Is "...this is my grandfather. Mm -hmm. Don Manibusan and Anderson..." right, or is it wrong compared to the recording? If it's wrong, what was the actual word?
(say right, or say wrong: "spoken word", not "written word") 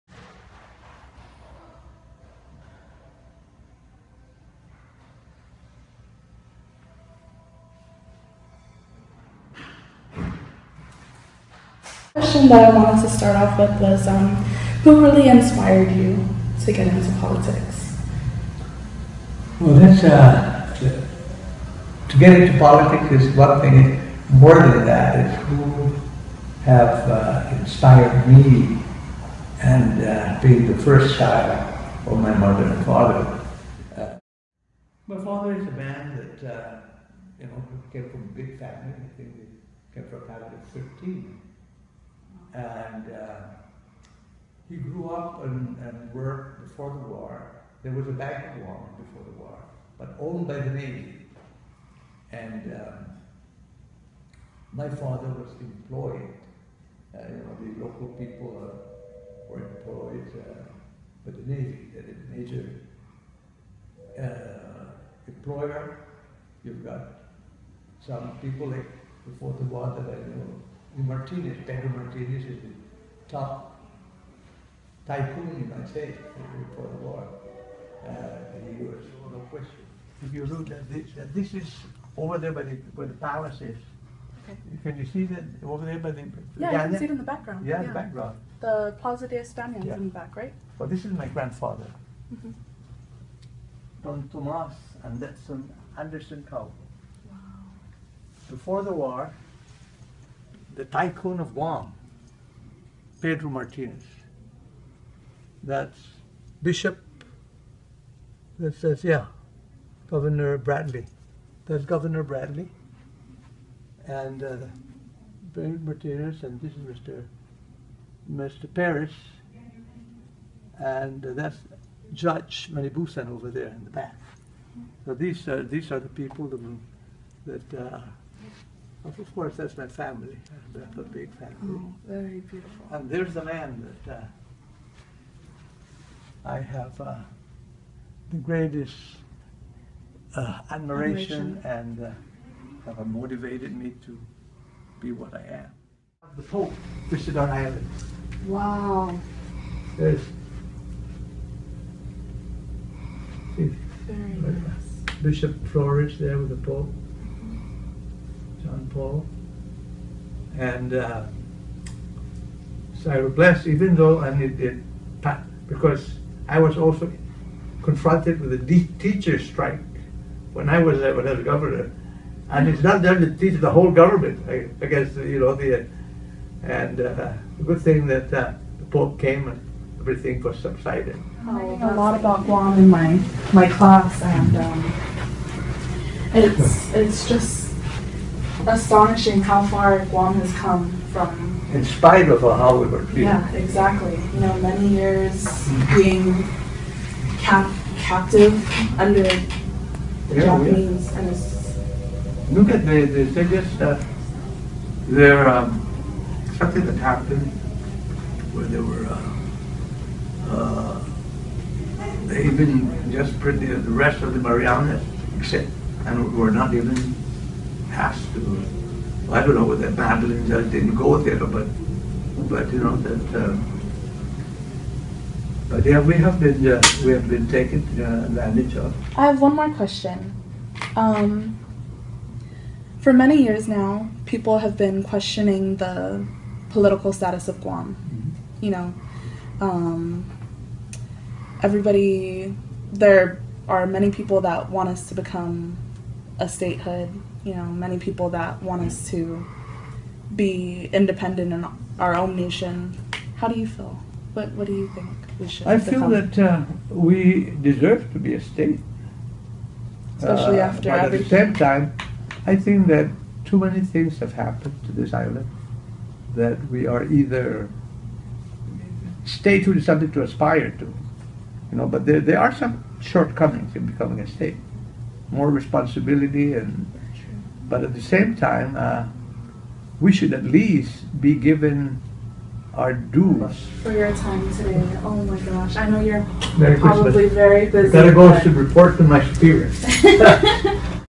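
wrong: "Tomas", not "Manibusan".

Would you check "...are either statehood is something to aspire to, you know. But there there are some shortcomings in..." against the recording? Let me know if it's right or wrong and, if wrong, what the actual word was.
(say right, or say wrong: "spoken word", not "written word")
right.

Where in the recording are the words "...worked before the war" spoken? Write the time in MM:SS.
00:46.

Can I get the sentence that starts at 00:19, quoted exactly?
Well, that's uh, to, to get into politics is one thing.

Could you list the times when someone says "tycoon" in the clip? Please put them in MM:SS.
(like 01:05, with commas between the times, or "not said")
01:15, 01:40.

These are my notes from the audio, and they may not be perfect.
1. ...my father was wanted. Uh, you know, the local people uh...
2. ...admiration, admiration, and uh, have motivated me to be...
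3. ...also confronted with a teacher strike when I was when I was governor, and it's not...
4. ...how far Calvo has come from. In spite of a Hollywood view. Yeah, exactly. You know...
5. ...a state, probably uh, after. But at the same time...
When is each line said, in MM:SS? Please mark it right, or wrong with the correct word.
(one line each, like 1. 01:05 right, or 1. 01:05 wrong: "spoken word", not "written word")
1. 00:54 wrong: "employed", not "wanted"
2. 02:20 right
3. 02:46 right
4. 03:09 wrong: "Guam", not "Calvo"
5. 04:18 wrong: "especially", not "probably".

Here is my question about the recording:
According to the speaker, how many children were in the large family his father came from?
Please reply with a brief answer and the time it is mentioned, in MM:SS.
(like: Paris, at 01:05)
13, at 00:40.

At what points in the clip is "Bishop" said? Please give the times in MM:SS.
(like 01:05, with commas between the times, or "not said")
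01:46, 02:35.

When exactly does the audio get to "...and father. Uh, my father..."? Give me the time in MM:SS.
00:32.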